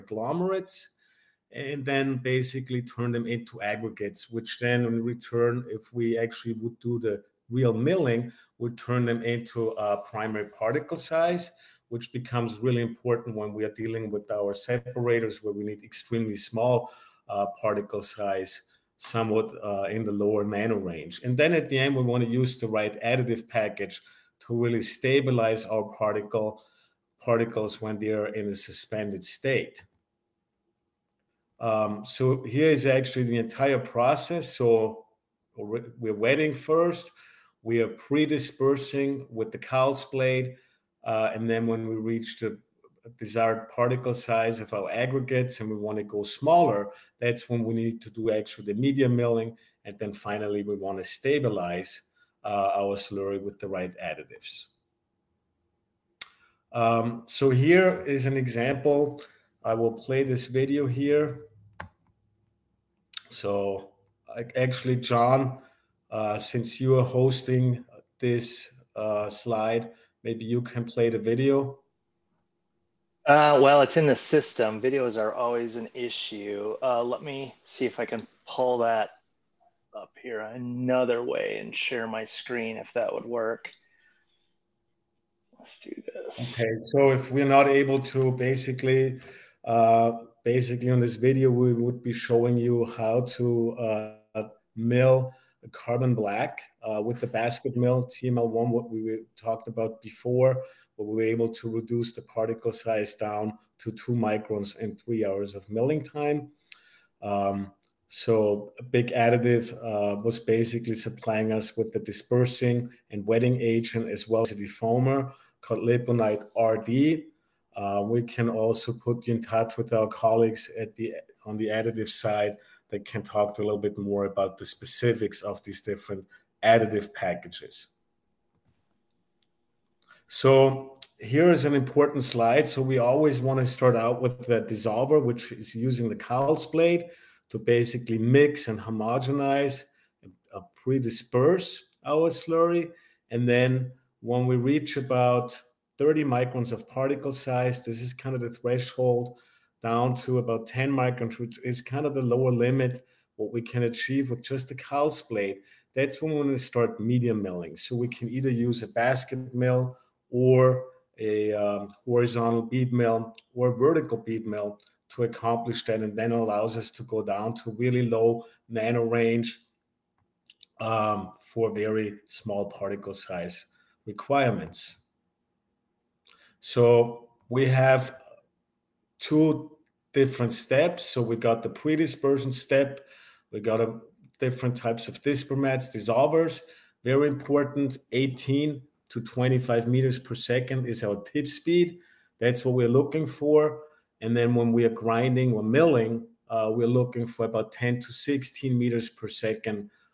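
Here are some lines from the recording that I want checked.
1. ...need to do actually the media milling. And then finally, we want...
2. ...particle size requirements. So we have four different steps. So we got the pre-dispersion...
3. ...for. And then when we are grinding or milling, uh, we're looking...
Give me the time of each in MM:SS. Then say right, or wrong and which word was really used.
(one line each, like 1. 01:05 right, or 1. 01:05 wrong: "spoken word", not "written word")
1. 00:47 right
2. 02:52 wrong: "two", not "four"
3. 03:13 right.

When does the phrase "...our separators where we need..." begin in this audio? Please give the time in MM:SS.
00:14.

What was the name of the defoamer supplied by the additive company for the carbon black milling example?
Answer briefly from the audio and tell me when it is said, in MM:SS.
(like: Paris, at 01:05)
Laponite RD, at 01:55.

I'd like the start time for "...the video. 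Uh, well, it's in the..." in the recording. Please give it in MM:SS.
01:11.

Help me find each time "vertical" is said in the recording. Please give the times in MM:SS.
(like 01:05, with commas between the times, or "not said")
02:43.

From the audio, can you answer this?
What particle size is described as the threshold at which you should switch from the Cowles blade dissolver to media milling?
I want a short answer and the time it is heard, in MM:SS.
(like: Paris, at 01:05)
30 microns, at 02:25.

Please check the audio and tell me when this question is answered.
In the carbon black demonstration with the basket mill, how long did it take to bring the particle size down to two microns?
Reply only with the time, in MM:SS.
01:44.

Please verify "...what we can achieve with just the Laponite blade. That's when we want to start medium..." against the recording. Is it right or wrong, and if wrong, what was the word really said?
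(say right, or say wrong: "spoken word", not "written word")
wrong: "Cowles", not "Laponite".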